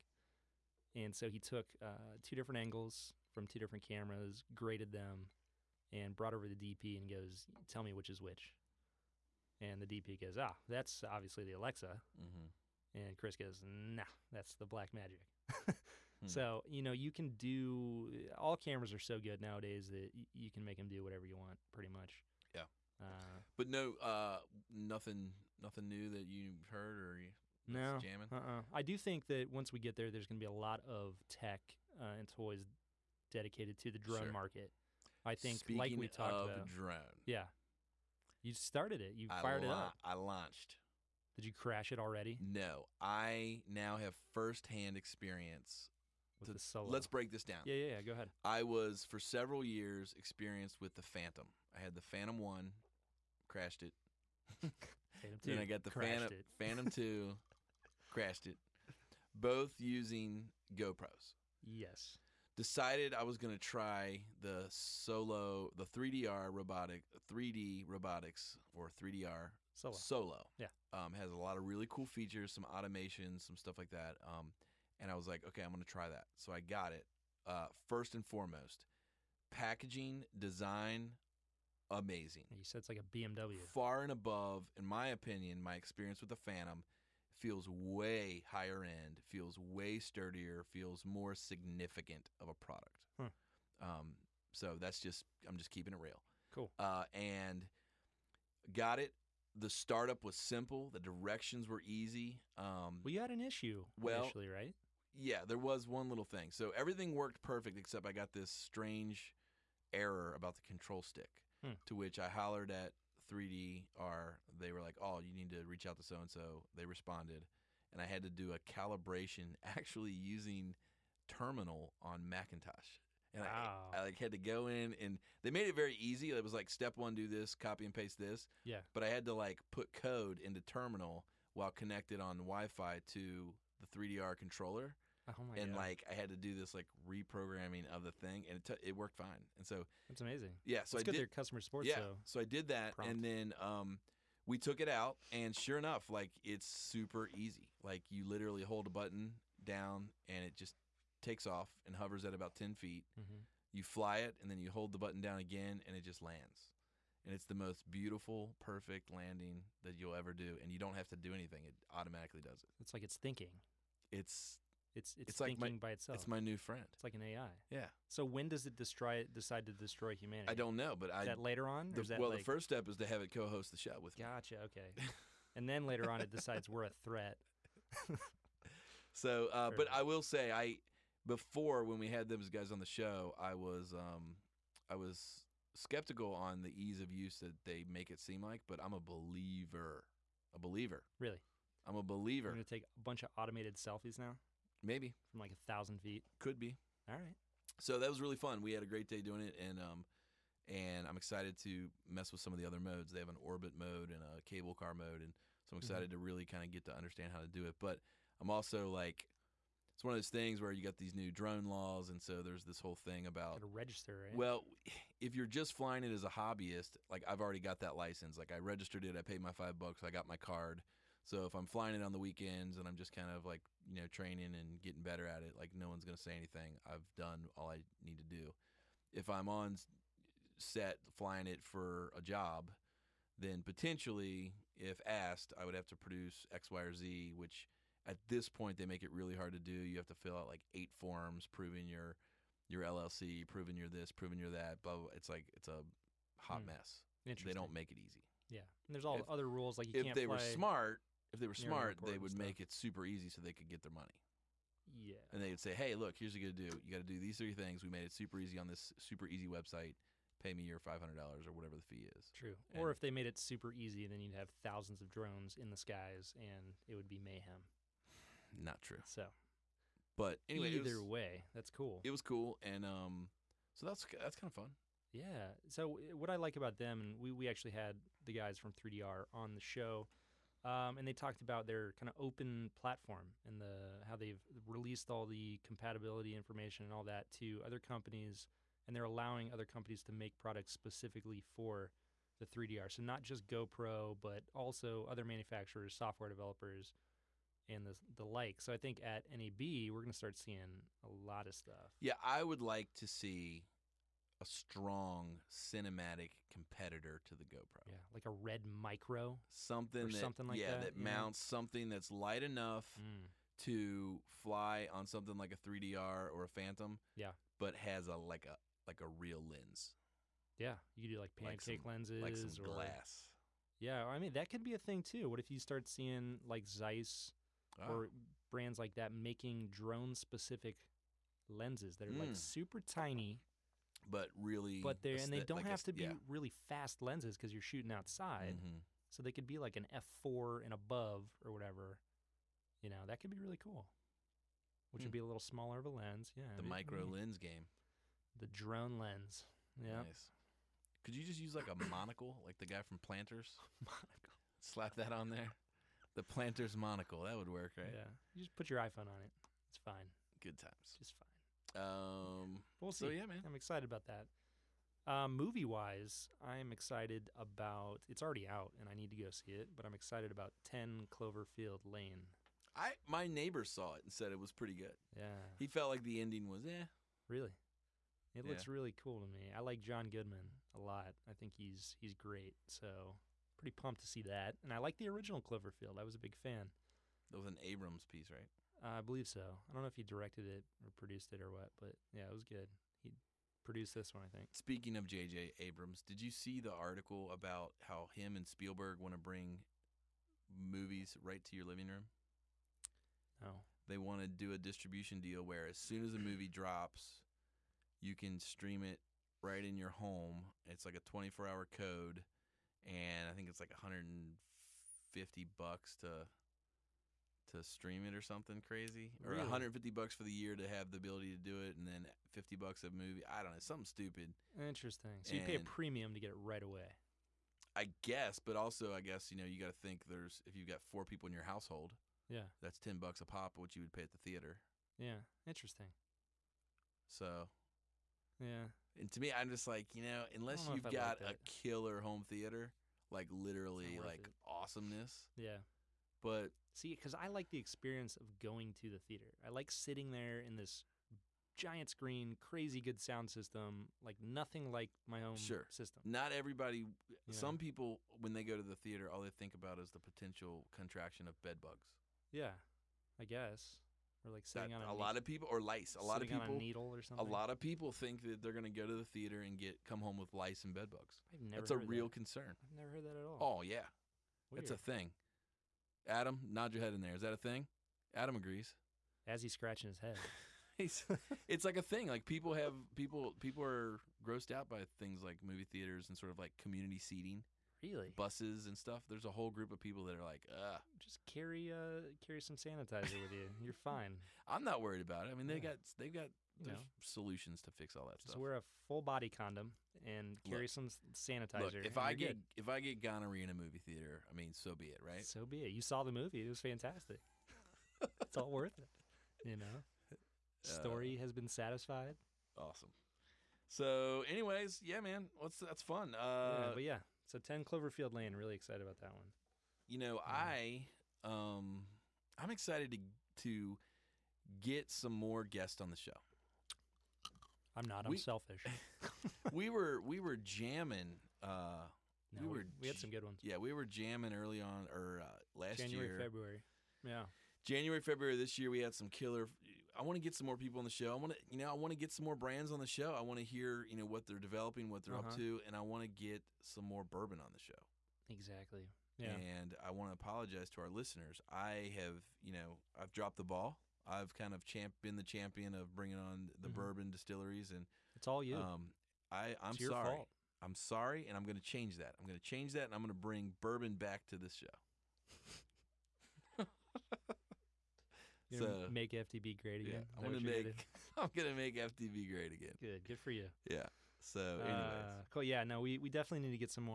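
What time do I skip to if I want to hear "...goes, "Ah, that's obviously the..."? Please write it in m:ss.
0:10.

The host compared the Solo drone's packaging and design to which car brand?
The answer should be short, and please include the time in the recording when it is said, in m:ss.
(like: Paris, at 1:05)
BMW, at 1:23.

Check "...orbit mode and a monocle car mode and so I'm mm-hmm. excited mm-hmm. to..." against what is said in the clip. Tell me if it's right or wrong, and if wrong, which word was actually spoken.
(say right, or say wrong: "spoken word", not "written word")
wrong: "cable", not "monocle".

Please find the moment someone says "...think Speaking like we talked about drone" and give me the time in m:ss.
0:35.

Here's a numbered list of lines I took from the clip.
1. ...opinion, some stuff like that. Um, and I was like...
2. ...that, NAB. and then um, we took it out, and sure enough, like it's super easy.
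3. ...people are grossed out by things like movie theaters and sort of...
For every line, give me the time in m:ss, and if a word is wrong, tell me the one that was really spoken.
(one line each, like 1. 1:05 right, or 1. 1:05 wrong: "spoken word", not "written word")
1. 1:12 wrong: "automation", not "opinion"
2. 2:22 wrong: "Prompt", not "NAB"
3. 8:03 right.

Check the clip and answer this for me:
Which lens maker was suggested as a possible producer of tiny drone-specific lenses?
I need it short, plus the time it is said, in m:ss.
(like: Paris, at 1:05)
Zeiss, at 5:26.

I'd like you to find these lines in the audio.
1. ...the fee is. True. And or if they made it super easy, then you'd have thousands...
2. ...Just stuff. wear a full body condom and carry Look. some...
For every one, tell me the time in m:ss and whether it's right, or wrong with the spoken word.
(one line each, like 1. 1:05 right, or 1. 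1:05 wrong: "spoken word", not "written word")
1. 4:21 right
2. 8:18 right.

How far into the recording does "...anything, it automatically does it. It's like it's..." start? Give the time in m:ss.
2:41.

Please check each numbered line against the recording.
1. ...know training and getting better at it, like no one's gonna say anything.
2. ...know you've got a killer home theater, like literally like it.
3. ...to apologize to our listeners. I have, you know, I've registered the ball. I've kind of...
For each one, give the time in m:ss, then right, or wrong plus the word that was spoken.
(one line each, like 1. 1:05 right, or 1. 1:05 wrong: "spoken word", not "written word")
1. 3:43 right
2. 7:20 right
3. 9:10 wrong: "dropped", not "registered".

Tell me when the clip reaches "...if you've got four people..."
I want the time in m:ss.
7:10.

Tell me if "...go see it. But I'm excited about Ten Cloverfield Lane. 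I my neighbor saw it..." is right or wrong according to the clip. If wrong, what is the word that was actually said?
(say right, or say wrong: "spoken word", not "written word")
right.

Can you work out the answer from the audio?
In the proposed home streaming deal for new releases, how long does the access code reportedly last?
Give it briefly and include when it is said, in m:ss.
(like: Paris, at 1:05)
24 hours, at 6:51.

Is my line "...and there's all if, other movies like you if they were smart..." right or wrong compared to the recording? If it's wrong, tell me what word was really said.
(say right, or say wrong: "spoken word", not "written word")
wrong: "rules", not "movies".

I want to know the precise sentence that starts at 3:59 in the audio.
You have to fill out like eight forms proving your your LLC, proving you're this, proving you're that.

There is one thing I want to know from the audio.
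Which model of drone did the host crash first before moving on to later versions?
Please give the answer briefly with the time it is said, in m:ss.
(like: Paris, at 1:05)
Phantom One, at 0:52.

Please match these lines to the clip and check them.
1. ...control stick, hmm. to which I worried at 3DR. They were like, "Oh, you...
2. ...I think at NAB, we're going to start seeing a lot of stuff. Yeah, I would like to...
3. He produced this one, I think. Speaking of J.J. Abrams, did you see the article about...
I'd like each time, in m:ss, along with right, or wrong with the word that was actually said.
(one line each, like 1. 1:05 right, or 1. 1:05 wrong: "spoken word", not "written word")
1. 1:50 wrong: "hollered", not "worried"
2. 4:58 right
3. 6:32 right.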